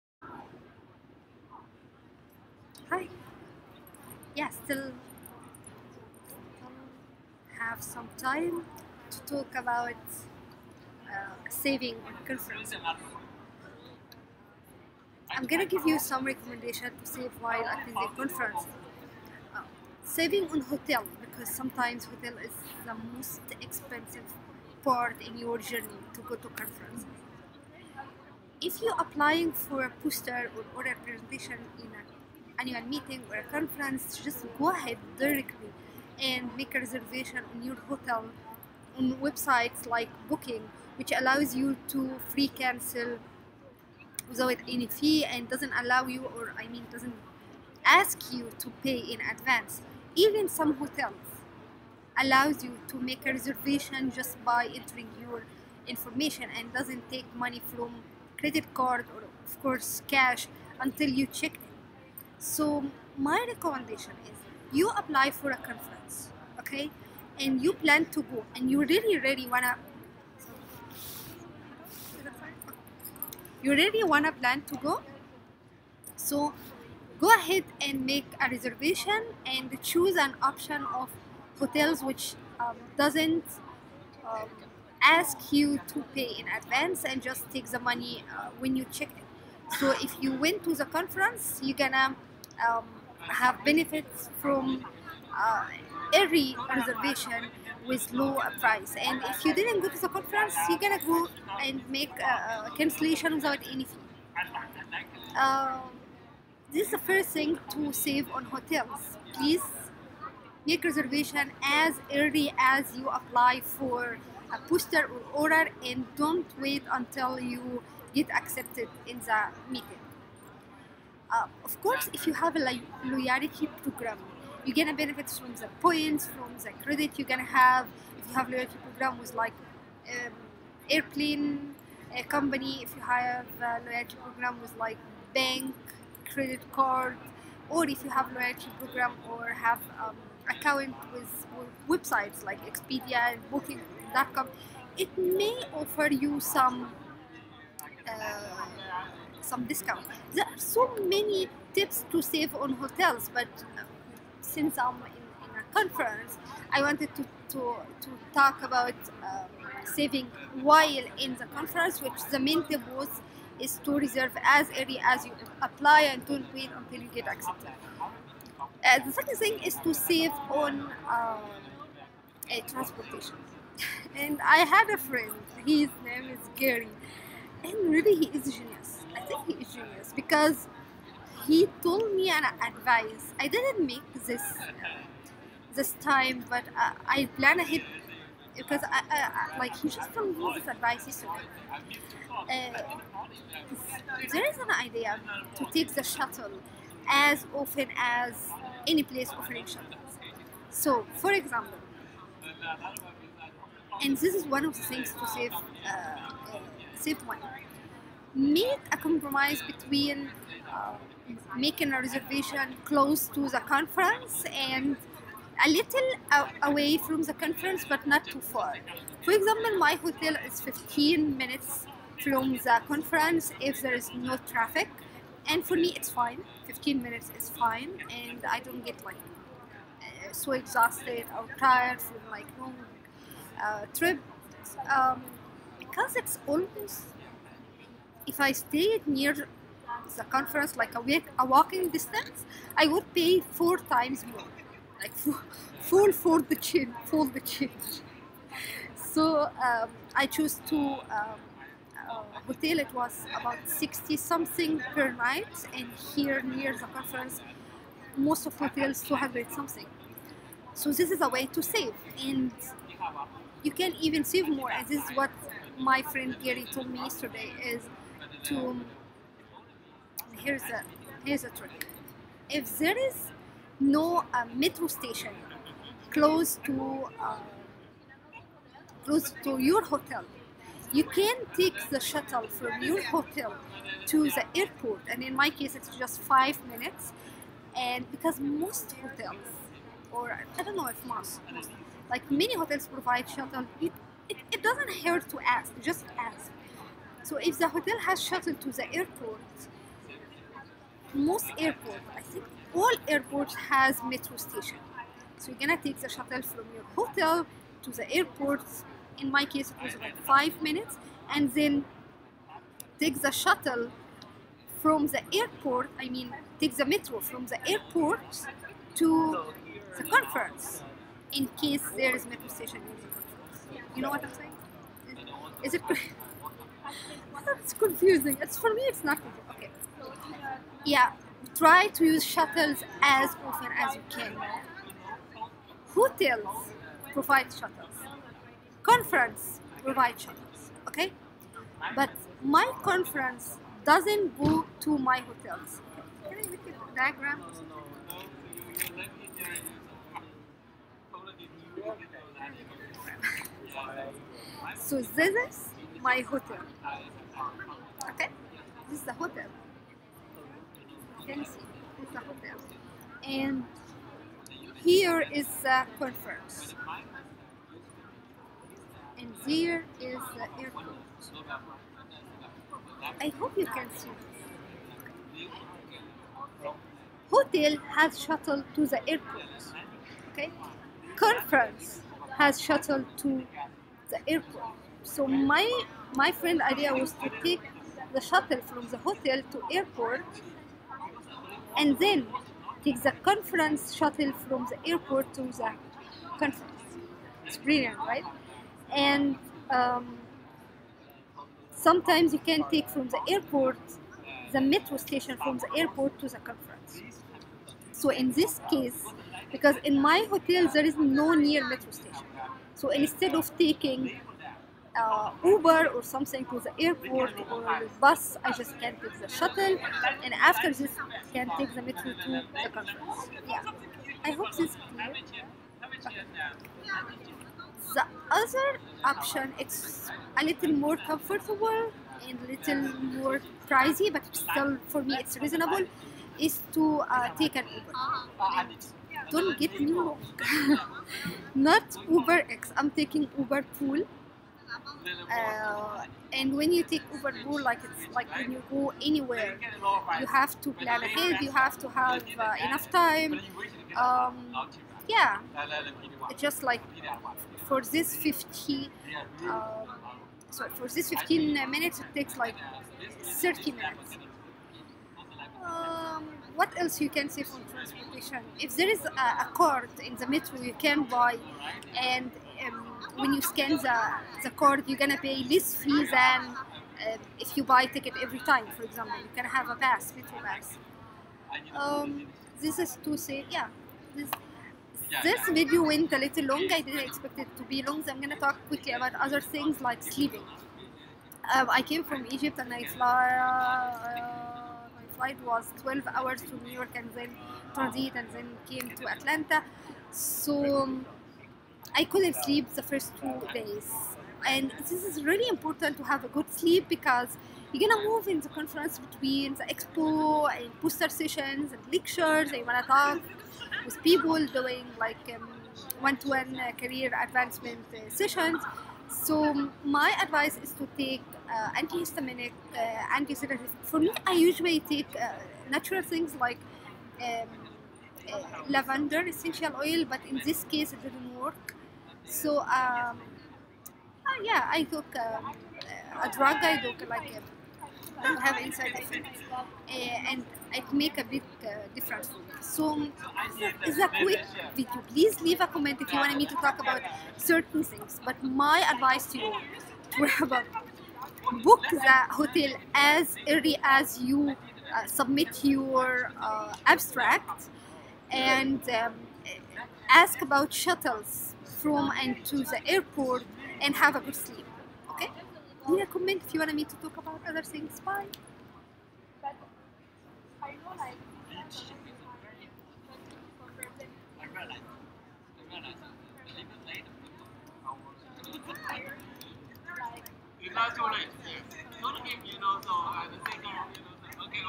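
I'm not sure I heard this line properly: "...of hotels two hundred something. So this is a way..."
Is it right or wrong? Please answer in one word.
right.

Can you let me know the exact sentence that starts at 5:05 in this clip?
So you're gonna take the shuttle from your hotel to the airport.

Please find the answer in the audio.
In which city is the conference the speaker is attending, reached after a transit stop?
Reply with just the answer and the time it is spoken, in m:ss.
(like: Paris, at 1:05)
Atlanta, at 8:19.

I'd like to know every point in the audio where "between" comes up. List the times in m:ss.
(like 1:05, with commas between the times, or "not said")
3:29, 8:28.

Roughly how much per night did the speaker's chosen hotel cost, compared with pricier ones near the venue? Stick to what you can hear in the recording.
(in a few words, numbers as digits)
sixty something.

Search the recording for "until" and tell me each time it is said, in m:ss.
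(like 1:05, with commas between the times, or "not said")
1:00, 1:56, 2:46.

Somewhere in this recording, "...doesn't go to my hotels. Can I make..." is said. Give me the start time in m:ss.
5:43.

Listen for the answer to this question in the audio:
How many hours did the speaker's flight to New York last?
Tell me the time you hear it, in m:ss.
8:15.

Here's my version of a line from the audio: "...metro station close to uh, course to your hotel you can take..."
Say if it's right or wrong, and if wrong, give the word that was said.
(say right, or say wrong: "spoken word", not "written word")
wrong: "close", not "course".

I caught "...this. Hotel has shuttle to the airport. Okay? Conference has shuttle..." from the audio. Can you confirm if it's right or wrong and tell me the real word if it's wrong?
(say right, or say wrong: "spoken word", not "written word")
right.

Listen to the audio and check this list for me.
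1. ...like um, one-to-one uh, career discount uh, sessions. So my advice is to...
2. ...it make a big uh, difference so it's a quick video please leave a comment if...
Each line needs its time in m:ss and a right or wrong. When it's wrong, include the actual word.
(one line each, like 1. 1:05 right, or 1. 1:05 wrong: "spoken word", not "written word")
1. 8:34 wrong: "advancement", not "discount"
2. 9:00 right.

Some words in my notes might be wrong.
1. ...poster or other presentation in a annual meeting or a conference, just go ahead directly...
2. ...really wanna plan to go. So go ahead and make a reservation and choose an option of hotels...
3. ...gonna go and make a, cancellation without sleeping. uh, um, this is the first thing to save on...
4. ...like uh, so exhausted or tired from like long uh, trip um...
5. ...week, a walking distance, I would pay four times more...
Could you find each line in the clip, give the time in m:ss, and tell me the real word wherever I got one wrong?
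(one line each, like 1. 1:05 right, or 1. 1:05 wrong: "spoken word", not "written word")
1. 0:30 right
2. 1:13 right
3. 1:40 wrong: "anything", not "sleeping"
4. 3:49 right
5. 4:01 right.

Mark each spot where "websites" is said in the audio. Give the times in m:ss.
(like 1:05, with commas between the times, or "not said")
0:39, 2:22.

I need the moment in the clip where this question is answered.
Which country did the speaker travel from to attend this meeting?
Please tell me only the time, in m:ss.
8:12.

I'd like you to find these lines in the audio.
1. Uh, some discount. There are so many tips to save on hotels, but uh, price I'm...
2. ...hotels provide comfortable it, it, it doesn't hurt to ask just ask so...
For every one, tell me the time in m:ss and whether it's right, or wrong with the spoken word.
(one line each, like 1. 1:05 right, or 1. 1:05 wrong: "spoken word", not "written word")
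1. 2:28 wrong: "since", not "price"
2. 4:52 wrong: "shuttle", not "comfortable".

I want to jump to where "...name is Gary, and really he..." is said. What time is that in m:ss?
2:56.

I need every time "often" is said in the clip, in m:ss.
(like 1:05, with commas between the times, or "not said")
3:17, 5:33.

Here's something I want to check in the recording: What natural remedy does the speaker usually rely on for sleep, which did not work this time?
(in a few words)
lavender essential oil.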